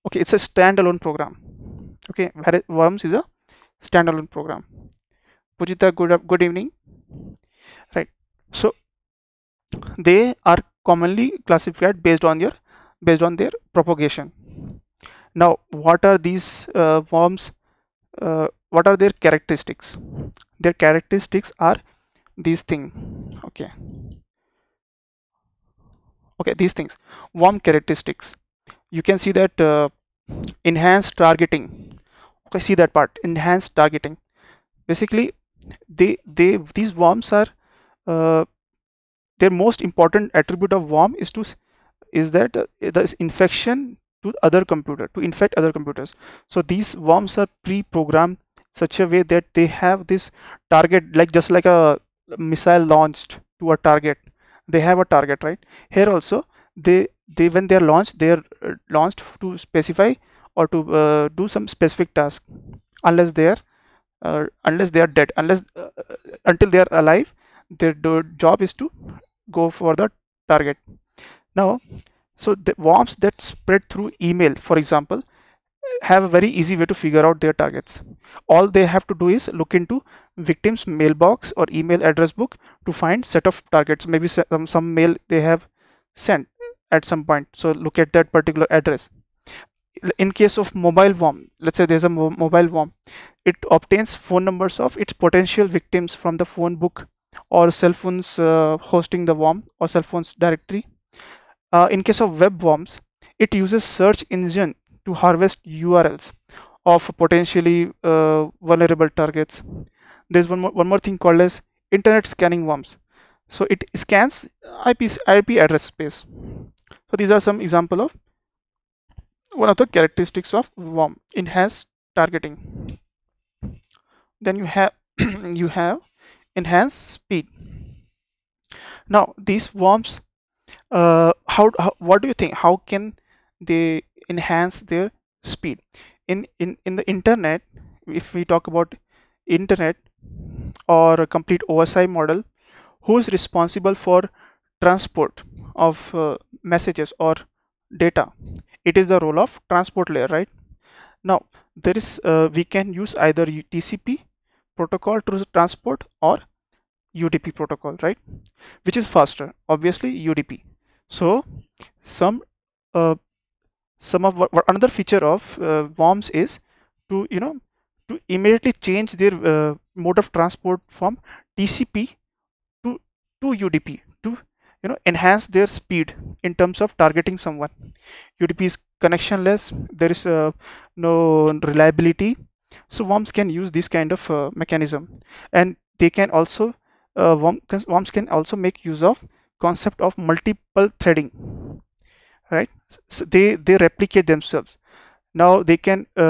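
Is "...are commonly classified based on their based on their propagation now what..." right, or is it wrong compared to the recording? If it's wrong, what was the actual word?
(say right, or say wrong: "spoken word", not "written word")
right.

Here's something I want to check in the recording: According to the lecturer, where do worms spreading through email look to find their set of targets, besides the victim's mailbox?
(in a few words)
Email address book.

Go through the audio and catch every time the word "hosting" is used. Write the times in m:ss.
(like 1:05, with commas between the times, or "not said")
1:38.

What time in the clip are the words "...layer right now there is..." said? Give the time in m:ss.
2:30.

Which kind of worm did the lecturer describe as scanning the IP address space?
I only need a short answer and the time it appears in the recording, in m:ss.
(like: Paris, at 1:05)
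Internet scanning worms, at 1:51.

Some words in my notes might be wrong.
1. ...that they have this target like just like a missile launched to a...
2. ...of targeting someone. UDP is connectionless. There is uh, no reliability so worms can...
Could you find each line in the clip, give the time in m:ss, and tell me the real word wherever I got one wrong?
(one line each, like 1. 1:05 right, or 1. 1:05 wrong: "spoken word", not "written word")
1. 0:49 right
2. 2:56 right.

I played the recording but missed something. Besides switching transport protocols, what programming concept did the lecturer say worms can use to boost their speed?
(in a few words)
Multiple threading.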